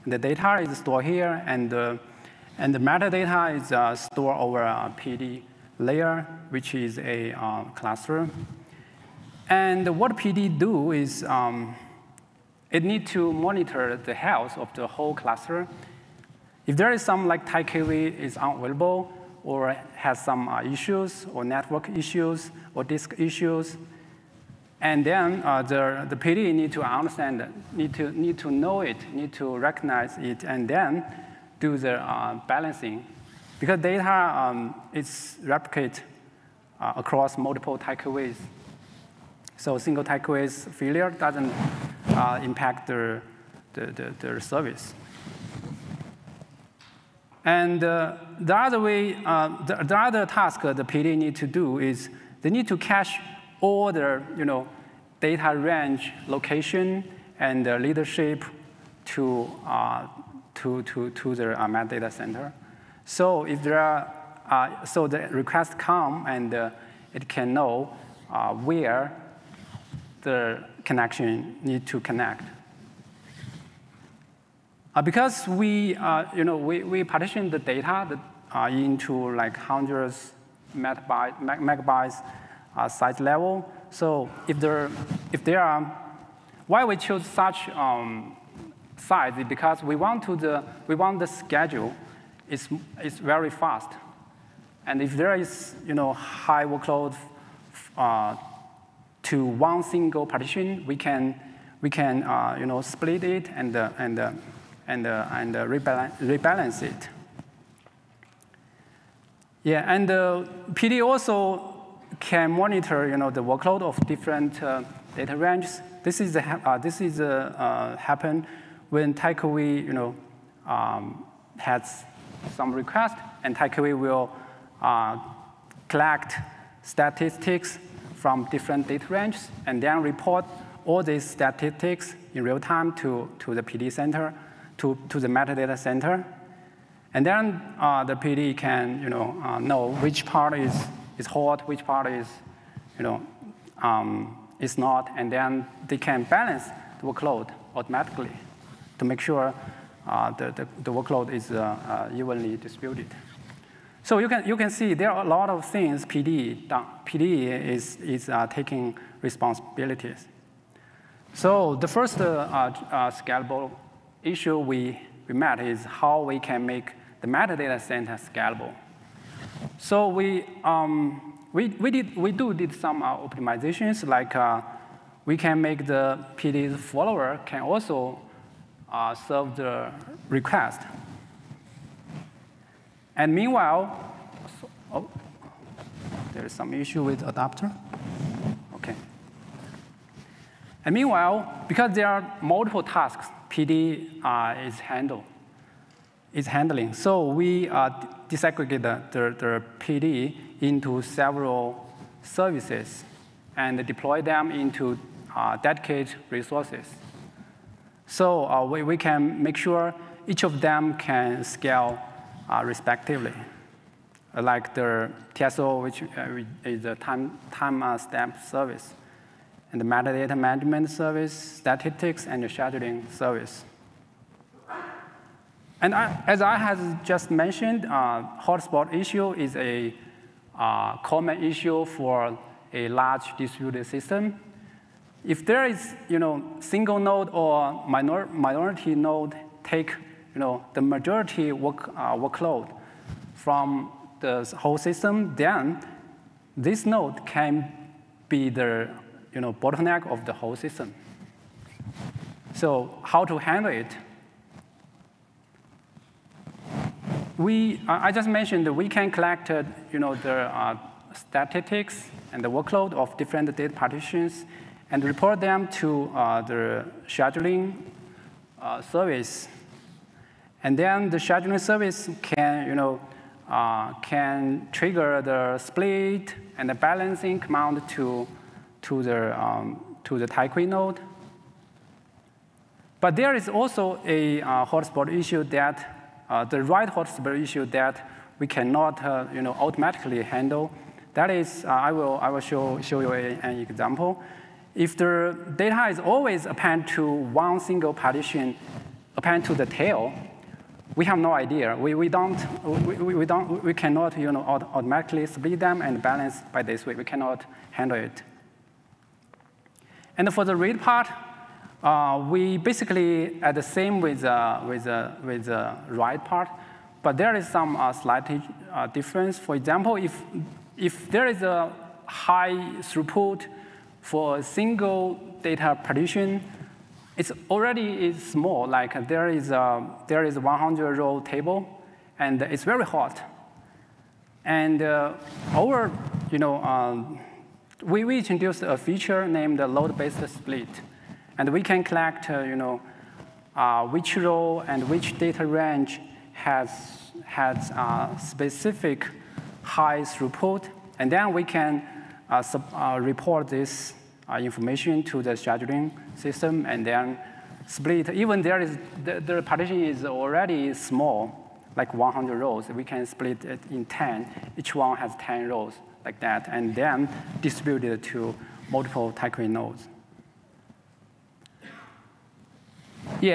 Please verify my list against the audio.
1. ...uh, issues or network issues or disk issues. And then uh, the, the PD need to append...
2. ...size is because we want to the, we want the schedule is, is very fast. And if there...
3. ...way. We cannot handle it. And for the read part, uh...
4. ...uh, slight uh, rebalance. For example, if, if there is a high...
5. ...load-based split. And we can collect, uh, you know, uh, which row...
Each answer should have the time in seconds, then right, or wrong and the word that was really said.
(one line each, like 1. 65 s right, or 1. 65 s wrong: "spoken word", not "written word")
1. 20 s wrong: "understand", not "append"
2. 88 s right
3. 306 s right
4. 317 s wrong: "difference", not "rebalance"
5. 339 s right.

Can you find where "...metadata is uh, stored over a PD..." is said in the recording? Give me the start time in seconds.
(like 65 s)
2 s.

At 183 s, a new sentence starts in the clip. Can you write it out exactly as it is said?
And meanwhile, so, oh, there is some issue with adapter.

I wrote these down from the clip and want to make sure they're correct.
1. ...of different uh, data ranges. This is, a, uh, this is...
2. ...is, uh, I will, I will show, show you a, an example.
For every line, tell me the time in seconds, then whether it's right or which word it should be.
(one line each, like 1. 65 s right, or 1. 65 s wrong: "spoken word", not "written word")
1. 113 s right
2. 291 s right.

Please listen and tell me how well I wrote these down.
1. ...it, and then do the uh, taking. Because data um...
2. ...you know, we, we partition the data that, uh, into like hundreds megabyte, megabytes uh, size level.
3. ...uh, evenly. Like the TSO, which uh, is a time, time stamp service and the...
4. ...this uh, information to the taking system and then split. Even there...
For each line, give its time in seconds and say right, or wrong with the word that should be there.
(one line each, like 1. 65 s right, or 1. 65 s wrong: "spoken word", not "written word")
1. 30 s wrong: "balancing", not "taking"
2. 76 s right
3. 212 s wrong: "respectively", not "evenly"
4. 353 s wrong: "scheduling", not "taking".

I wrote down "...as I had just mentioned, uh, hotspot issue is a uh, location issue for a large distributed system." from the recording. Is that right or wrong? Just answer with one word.
wrong.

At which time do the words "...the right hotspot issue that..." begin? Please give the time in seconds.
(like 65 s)
286 s.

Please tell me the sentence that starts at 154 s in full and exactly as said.
So you can, you can see there are a lot of things PD uh, PD is, is taking responsibilities.